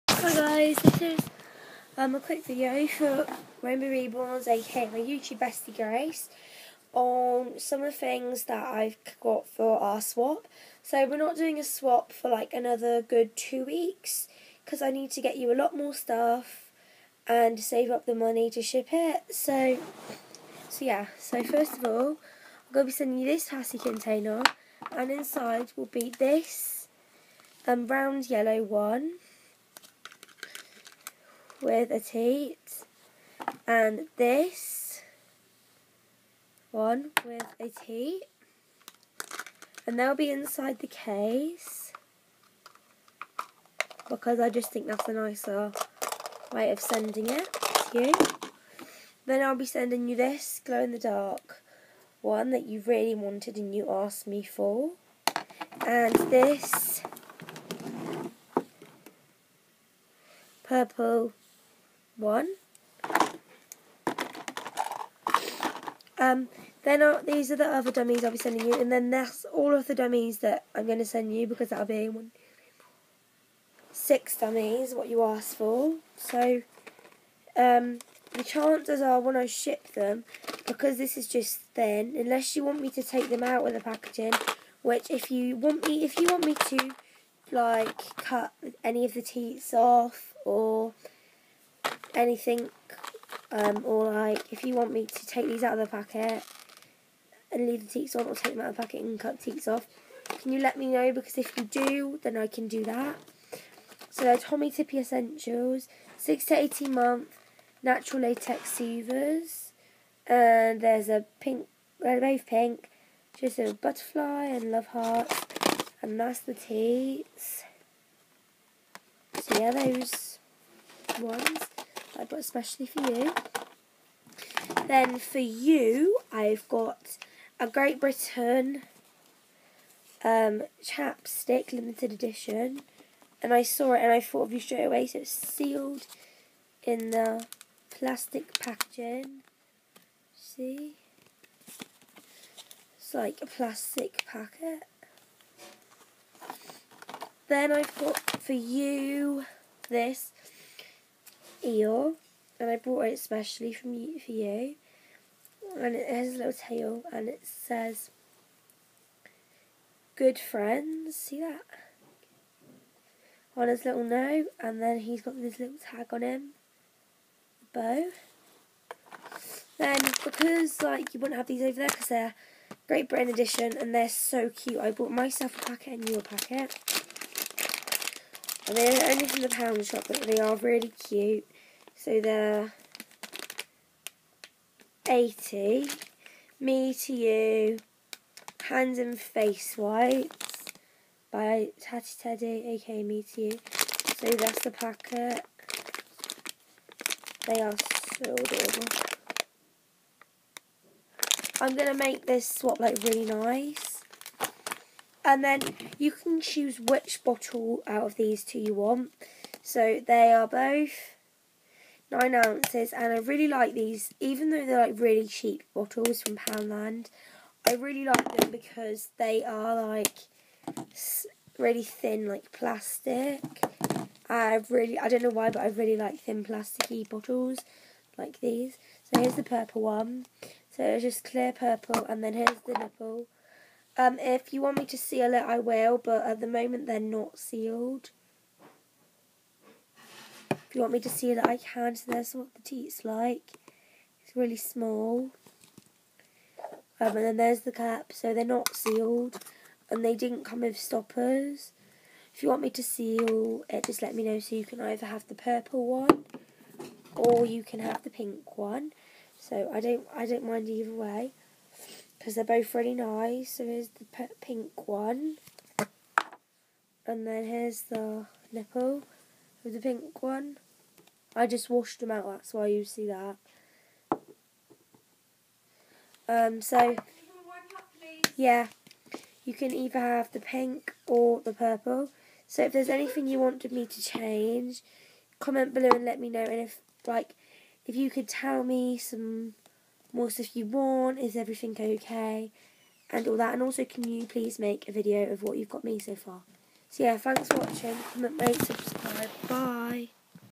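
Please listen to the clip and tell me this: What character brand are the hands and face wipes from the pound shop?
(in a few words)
Tatty Teddy.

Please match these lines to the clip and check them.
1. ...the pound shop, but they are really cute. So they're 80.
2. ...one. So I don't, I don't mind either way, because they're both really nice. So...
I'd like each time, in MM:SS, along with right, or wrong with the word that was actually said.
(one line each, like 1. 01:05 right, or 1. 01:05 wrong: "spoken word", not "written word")
1. 02:59 right
2. 04:18 right.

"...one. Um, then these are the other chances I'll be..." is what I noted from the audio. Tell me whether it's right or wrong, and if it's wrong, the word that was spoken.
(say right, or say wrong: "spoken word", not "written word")
wrong: "dummies", not "chances".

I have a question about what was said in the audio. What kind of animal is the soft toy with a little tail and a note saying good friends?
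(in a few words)
Eel.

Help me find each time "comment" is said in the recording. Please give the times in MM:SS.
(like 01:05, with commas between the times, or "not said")
04:45, 04:58.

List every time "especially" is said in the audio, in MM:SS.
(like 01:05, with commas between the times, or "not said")
02:02, 02:33.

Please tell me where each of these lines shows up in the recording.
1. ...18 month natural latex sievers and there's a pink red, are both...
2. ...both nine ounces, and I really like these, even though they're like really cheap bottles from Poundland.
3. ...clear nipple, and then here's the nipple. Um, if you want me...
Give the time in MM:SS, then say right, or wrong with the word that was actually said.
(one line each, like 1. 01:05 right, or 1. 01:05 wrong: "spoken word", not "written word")
1. 01:46 right
2. 03:30 right
3. 03:51 wrong: "purple", not "nipple".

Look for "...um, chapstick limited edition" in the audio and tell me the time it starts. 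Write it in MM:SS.
02:10.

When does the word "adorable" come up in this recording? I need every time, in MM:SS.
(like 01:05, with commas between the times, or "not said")
03:18.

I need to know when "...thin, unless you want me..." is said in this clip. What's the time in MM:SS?
01:21.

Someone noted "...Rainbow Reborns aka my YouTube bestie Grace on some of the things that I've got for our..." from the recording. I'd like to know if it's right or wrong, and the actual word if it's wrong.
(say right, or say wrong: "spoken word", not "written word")
right.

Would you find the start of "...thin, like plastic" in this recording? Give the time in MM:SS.
03:41.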